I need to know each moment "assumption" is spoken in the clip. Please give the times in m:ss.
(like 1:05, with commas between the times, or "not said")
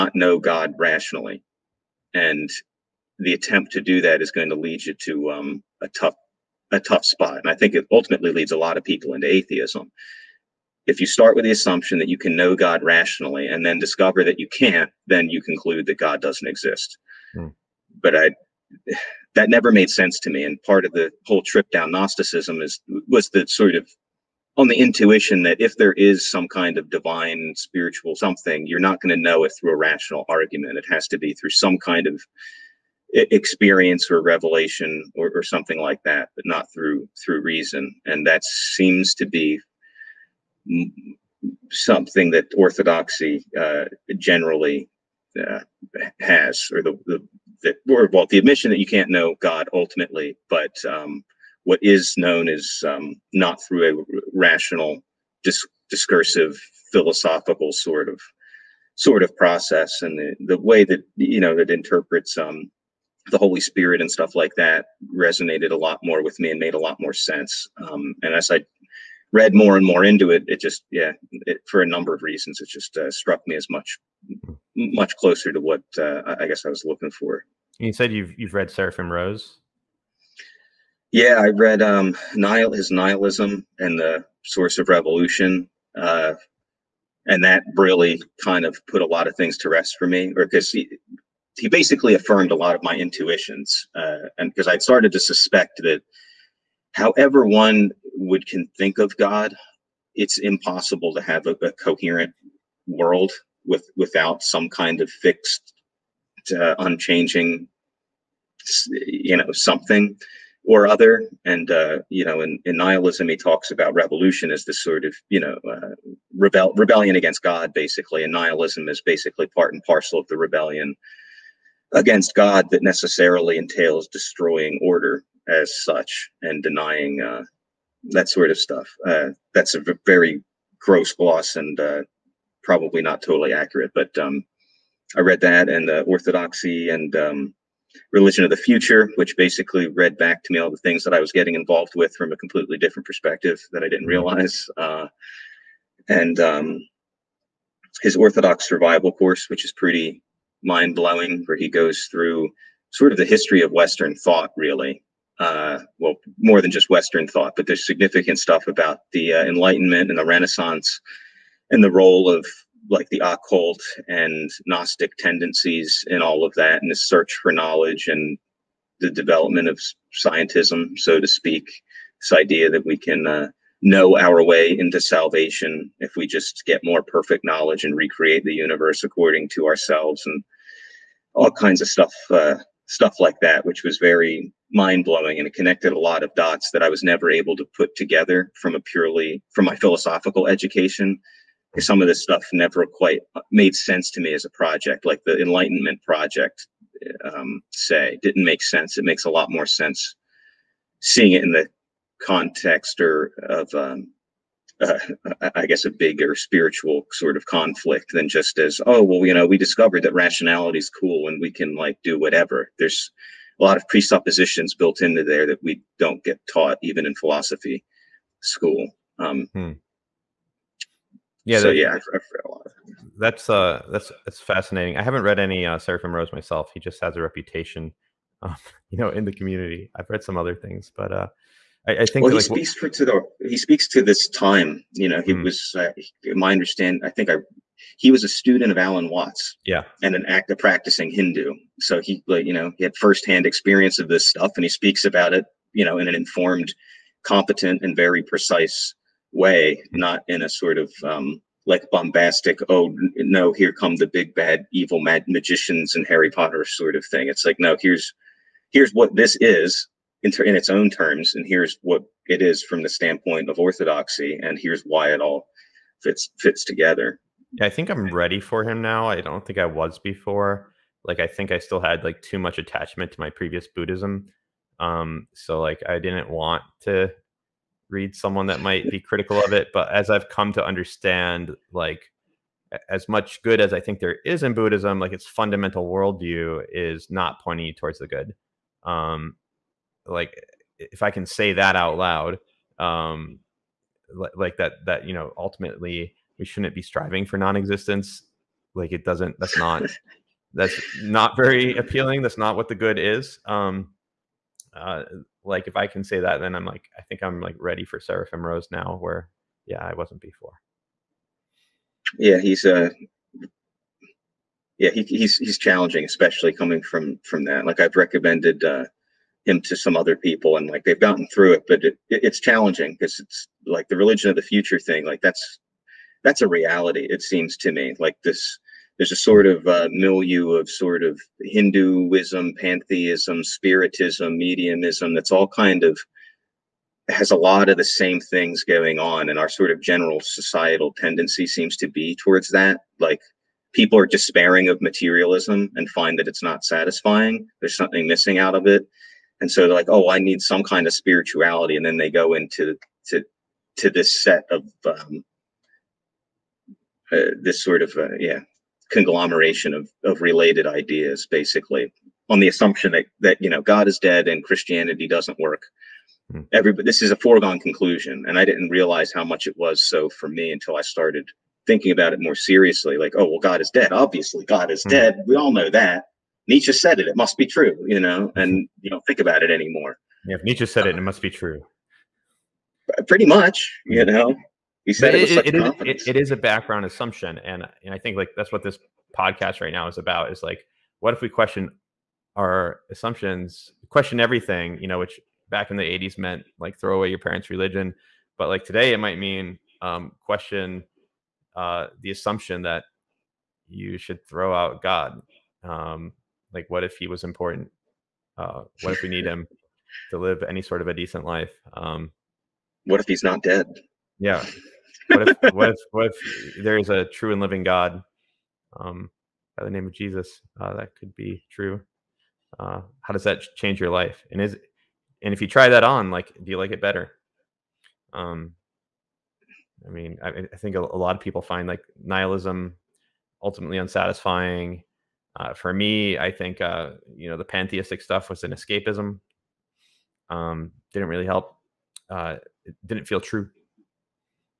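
0:11, 6:02, 6:26, 6:32, 6:42.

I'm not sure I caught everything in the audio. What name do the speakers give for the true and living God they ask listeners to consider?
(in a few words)
Jesus.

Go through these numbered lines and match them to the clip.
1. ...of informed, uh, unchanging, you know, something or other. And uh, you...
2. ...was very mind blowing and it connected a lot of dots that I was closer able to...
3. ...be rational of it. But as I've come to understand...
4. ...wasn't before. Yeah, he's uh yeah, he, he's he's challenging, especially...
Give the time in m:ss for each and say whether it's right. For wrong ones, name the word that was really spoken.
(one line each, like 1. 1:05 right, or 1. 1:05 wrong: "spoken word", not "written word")
1. 1:45 wrong: "fixed", not "informed"
2. 3:03 wrong: "never", not "closer"
3. 4:38 wrong: "critical", not "rational"
4. 5:09 right.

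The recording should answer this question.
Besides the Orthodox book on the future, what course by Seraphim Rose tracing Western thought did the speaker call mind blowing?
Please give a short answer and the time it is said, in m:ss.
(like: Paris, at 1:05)
Orthodox Survival course, at 2:28.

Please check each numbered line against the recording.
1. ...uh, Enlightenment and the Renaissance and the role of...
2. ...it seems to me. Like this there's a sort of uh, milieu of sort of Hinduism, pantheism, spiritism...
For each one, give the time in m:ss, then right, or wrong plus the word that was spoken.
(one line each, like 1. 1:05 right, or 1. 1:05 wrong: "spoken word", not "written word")
1. 2:39 right
2. 5:27 right.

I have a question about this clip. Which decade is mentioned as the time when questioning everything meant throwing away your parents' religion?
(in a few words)
the '80s.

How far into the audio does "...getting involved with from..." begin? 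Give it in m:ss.
2:21.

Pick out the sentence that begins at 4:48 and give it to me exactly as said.
Um, like if I can say that out loud, um, like that that you know ultimately we shouldn't be striving for non-existence.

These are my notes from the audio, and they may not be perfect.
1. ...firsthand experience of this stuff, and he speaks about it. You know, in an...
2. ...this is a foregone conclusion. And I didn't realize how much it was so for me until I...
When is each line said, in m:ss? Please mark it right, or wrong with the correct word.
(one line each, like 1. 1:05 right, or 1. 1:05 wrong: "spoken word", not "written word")
1. 4:02 right
2. 6:06 right.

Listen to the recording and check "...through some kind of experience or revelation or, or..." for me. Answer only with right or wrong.
right.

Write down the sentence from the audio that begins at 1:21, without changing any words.
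Yeah, I read um, Nihil is Nihilism and the Source of Revolution.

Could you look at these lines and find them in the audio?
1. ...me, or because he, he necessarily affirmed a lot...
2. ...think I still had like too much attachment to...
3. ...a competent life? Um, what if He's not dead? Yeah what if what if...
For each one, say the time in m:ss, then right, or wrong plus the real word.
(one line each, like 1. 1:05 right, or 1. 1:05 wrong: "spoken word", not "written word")
1. 1:30 wrong: "basically", not "necessarily"
2. 4:31 right
3. 6:50 wrong: "decent", not "competent".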